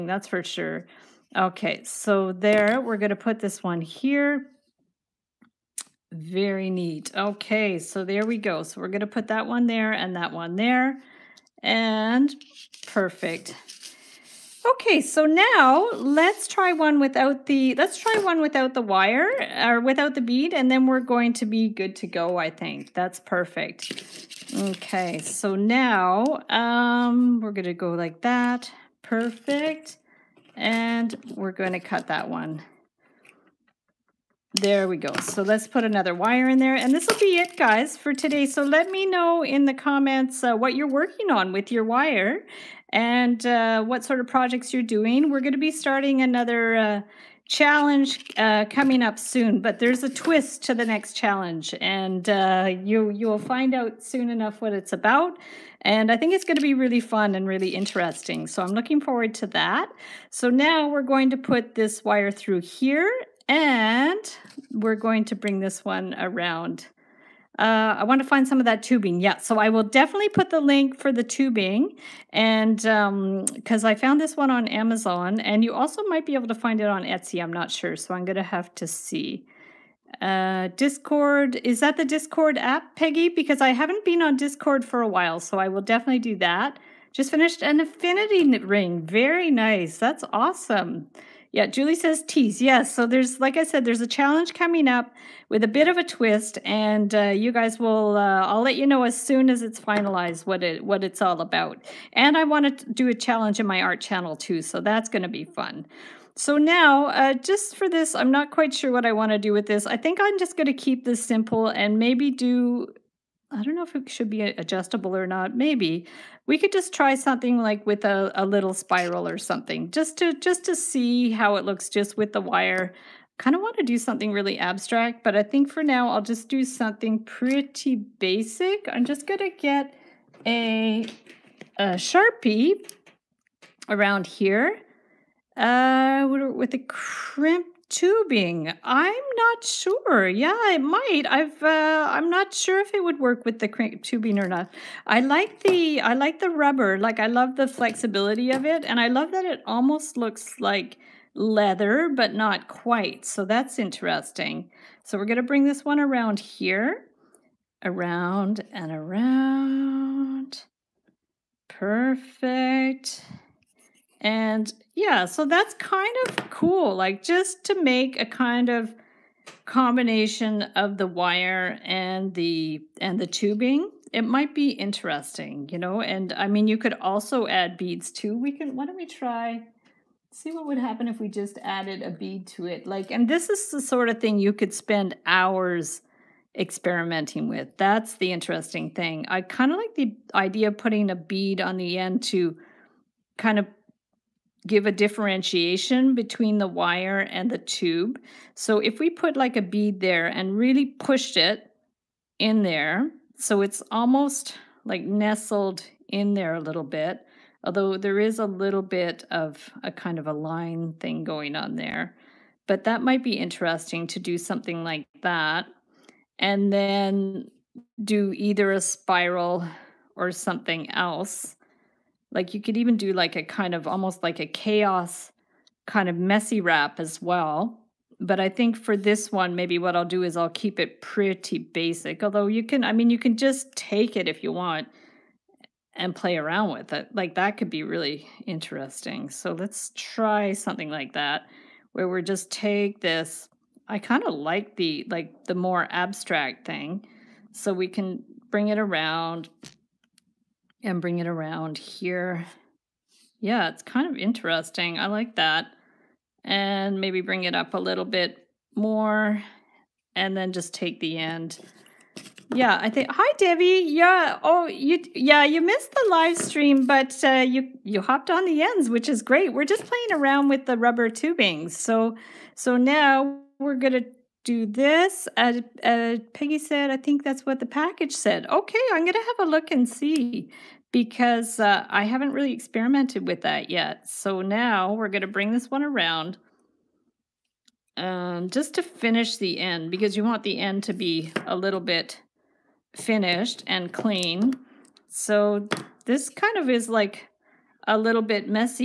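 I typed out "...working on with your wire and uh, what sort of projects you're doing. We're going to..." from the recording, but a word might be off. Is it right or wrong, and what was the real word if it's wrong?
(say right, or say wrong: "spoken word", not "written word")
right.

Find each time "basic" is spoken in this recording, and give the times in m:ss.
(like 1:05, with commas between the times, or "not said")
2:07, 3:51.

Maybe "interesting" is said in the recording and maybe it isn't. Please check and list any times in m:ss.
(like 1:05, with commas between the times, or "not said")
0:57, 2:33, 2:54, 3:08, 3:33, 3:58, 4:14.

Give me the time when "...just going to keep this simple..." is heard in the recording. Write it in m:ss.
1:50.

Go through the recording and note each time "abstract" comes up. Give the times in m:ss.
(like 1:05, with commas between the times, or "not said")
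2:04, 4:05.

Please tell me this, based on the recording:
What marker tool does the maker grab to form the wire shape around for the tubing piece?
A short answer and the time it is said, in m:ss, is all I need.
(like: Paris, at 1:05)
sharpie, at 2:11.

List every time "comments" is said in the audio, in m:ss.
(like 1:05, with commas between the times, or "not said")
0:39.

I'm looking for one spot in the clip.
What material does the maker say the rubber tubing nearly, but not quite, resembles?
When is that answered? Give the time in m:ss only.
2:31.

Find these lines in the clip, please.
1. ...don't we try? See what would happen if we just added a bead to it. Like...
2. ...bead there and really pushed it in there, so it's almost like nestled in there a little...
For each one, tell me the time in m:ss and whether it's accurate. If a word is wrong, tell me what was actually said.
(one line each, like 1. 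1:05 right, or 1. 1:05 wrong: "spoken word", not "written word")
1. 2:58 right
2. 3:19 right.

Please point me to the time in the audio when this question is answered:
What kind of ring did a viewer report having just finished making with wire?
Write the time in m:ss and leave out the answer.
1:27.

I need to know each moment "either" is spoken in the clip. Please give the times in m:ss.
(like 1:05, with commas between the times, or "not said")
3:38.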